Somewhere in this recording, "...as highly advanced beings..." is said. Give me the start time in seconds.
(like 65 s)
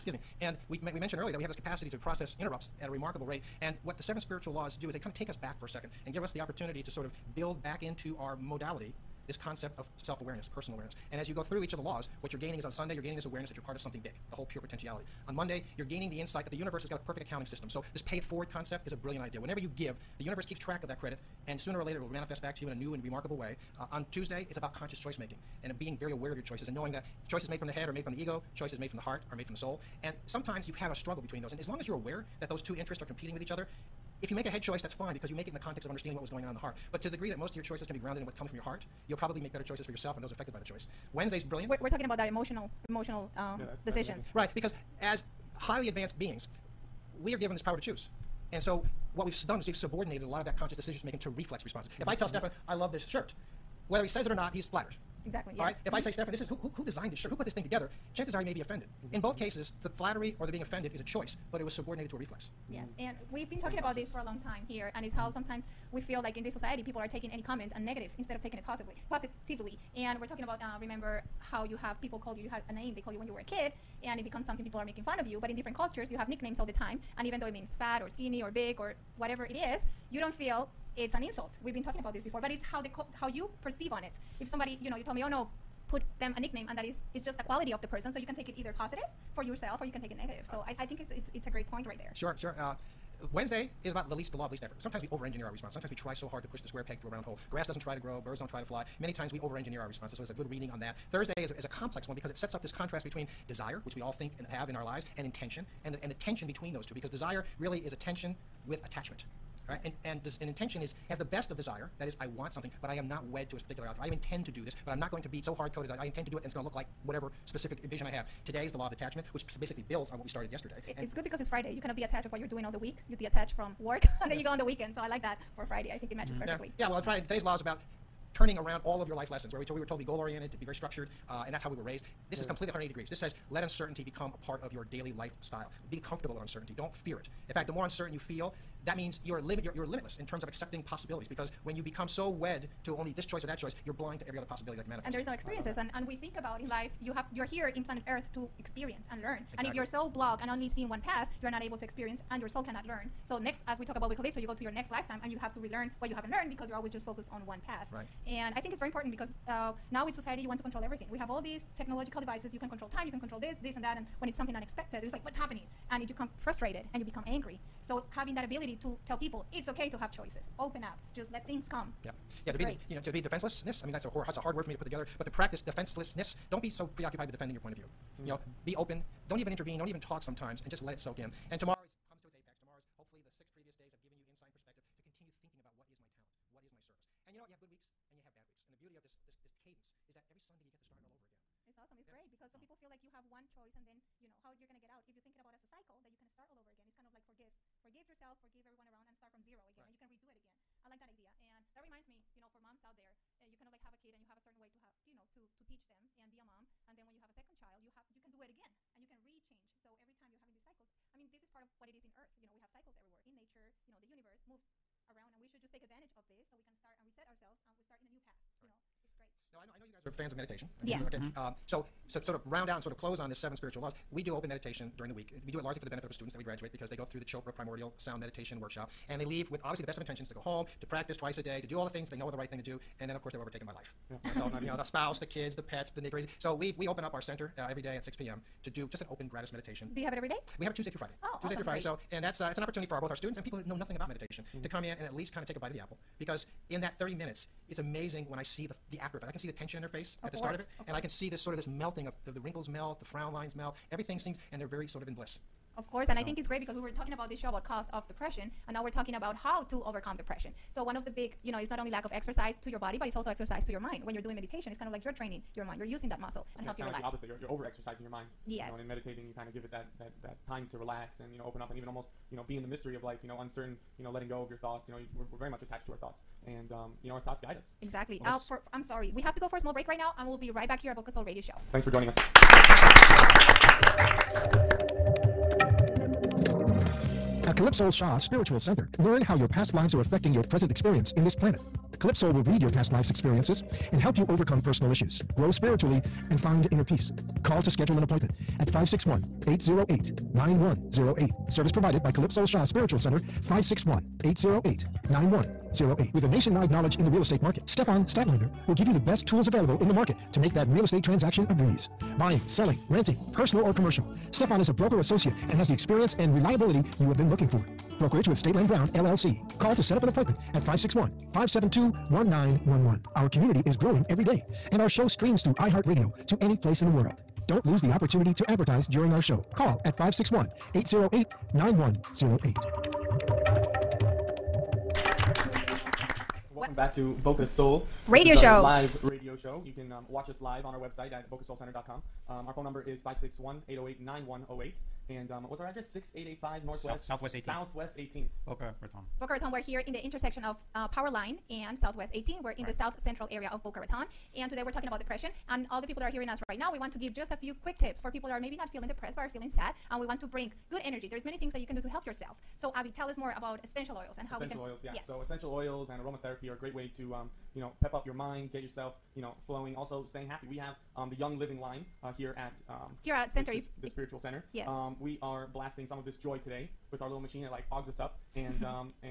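44 s.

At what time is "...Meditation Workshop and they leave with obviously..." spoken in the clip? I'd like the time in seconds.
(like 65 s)
228 s.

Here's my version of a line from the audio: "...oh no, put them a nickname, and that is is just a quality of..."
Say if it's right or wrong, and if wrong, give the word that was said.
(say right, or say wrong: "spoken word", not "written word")
right.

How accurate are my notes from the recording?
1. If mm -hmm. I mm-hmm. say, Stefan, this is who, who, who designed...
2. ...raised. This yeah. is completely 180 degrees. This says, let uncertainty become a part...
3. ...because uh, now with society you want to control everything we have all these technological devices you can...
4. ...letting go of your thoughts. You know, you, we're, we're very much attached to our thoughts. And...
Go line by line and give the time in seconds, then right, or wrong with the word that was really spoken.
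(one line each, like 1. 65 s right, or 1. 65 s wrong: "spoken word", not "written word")
1. 55 s right
2. 131 s right
3. 159 s right
4. 274 s right.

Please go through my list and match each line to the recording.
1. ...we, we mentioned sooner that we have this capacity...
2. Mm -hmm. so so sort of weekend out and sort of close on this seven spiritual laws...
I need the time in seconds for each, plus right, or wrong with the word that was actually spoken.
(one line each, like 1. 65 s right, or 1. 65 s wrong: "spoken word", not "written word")
1. 0 s wrong: "earlier", not "sooner"
2. 221 s wrong: "round", not "weekend".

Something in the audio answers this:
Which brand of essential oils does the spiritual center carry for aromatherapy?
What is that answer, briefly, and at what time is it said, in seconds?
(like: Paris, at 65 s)
Young Living, at 371 s.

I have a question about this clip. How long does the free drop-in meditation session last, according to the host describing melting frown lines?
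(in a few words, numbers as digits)
30 minutes.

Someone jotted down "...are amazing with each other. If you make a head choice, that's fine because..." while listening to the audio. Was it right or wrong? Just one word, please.
wrong.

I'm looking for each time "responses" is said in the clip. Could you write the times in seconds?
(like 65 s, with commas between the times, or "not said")
51 s, 95 s, 99 s.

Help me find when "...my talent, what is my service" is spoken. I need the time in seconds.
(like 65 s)
185 s.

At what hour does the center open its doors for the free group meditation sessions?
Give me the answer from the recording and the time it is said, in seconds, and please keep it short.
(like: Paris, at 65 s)
6 p.m., at 238 s.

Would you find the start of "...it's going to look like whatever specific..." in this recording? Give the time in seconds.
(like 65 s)
116 s.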